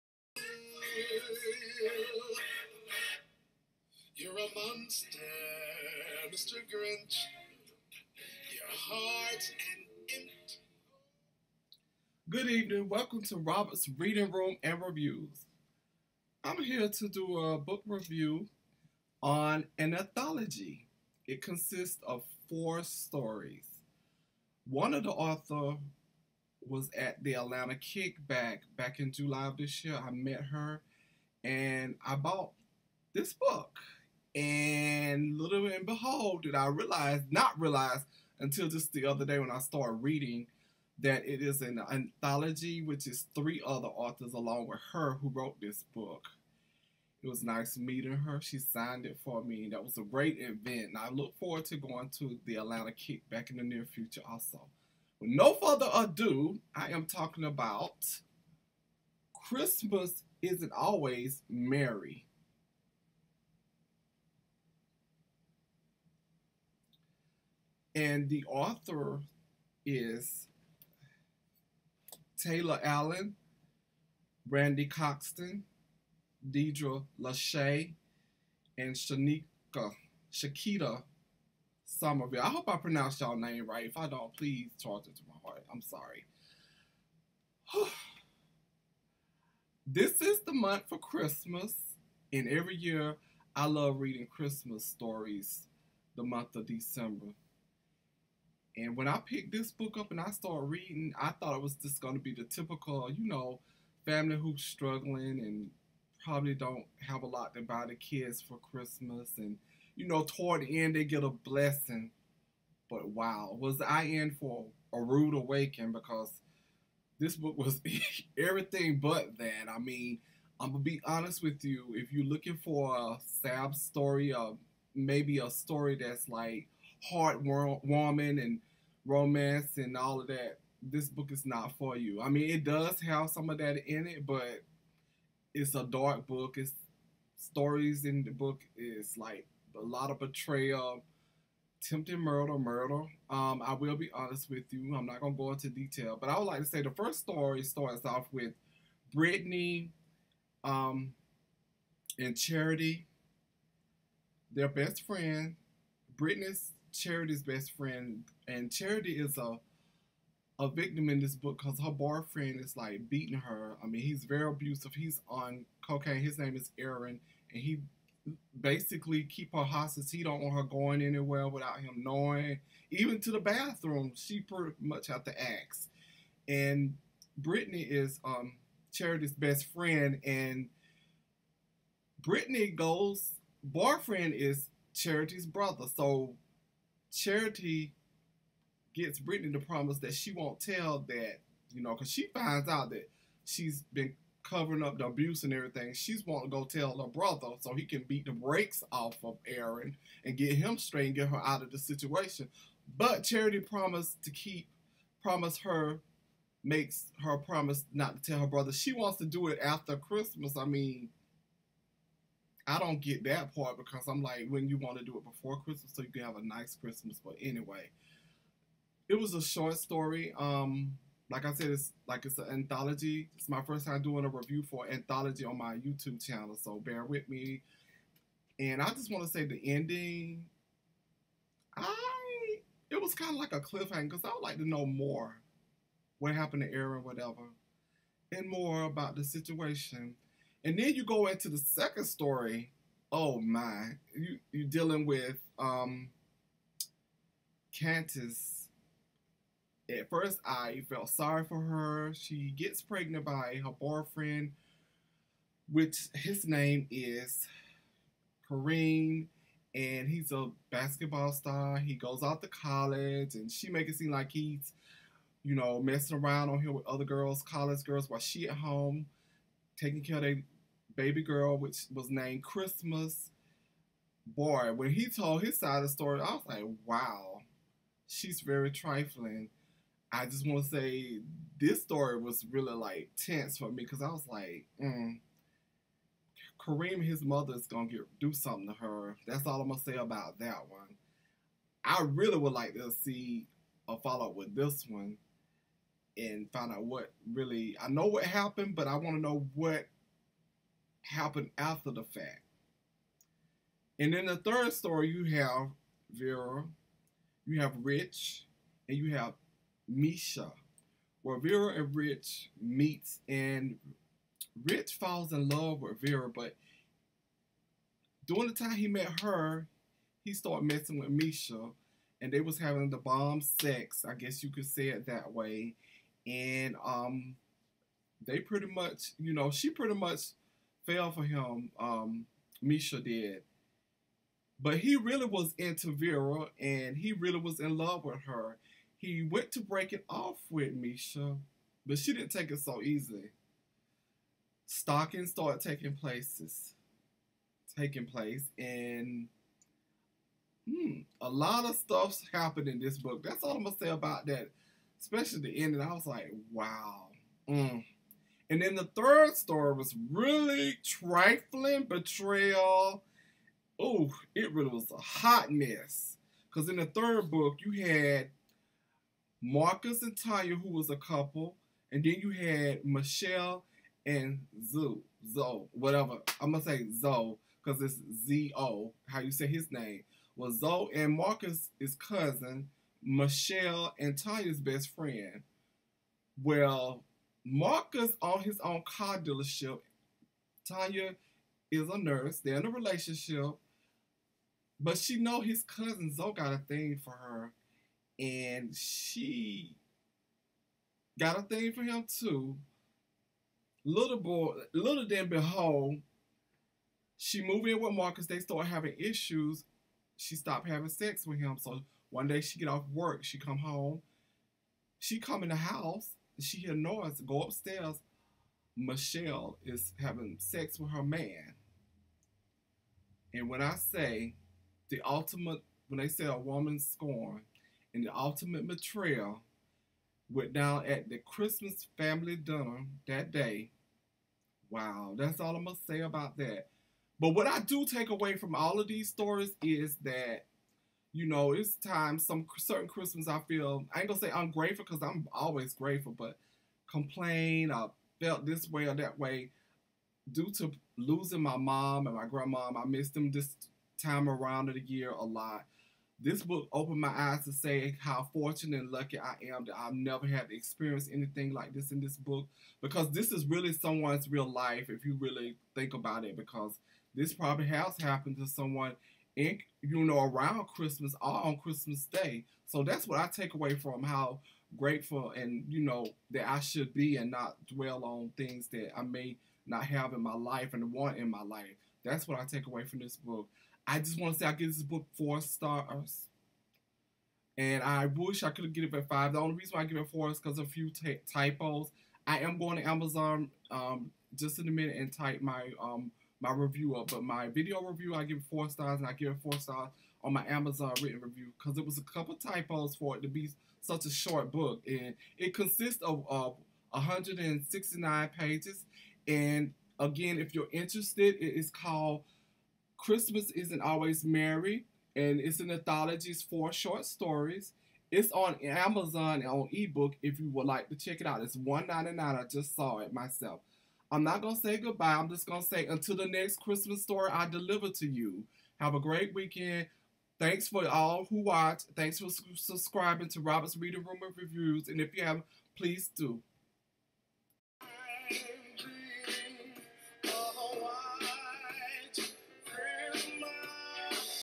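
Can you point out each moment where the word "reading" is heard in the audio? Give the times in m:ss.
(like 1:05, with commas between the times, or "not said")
0:13, 0:40, 1:33, 1:40, 8:53.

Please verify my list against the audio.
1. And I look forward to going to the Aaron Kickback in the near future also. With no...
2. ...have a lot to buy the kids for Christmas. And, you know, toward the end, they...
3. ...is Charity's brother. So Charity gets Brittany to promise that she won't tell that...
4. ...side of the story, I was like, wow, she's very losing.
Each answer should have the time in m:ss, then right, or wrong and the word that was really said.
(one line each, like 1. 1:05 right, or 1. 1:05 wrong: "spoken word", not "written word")
1. 0:50 wrong: "Atlanta", not "Aaron"
2. 1:47 right
3. 3:04 right
4. 4:35 wrong: "trifling", not "losing".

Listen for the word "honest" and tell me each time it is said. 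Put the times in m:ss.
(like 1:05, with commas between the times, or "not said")
2:01, 2:24.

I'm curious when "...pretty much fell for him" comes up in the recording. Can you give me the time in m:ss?
5:29.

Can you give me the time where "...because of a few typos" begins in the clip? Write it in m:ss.
8:10.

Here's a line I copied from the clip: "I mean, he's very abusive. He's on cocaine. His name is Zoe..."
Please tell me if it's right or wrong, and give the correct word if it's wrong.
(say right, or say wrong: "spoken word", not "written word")
wrong: "Aaron", not "Zoe".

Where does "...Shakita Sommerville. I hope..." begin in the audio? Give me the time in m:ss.
1:20.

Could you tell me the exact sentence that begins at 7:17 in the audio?
But what I do take away from all of these stories is that you know, it's time.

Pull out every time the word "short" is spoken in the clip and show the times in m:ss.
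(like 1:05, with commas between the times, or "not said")
3:39, 8:24, 8:36.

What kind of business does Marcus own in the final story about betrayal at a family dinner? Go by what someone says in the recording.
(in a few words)
car dealership.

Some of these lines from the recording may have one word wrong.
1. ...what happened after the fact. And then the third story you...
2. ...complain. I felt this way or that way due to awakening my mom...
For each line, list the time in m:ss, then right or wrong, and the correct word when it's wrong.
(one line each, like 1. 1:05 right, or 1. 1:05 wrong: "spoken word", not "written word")
1. 4:59 right
2. 7:26 wrong: "losing", not "awakening".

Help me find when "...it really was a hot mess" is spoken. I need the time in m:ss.
6:04.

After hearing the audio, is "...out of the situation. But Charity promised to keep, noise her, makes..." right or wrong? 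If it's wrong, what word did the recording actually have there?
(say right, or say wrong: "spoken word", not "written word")
wrong: "promise", not "noise".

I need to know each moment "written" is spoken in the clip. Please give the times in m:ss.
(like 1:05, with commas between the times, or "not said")
8:21.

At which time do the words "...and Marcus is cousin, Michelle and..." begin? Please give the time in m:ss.
6:20.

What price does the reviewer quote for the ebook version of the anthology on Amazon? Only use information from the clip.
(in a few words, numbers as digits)
$1.99.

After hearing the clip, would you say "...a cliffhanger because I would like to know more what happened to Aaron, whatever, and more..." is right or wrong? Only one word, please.
right.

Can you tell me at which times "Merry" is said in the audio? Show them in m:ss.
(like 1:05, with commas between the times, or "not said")
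1:01, 8:34.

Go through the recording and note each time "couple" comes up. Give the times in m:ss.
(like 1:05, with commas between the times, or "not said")
6:10, 8:22.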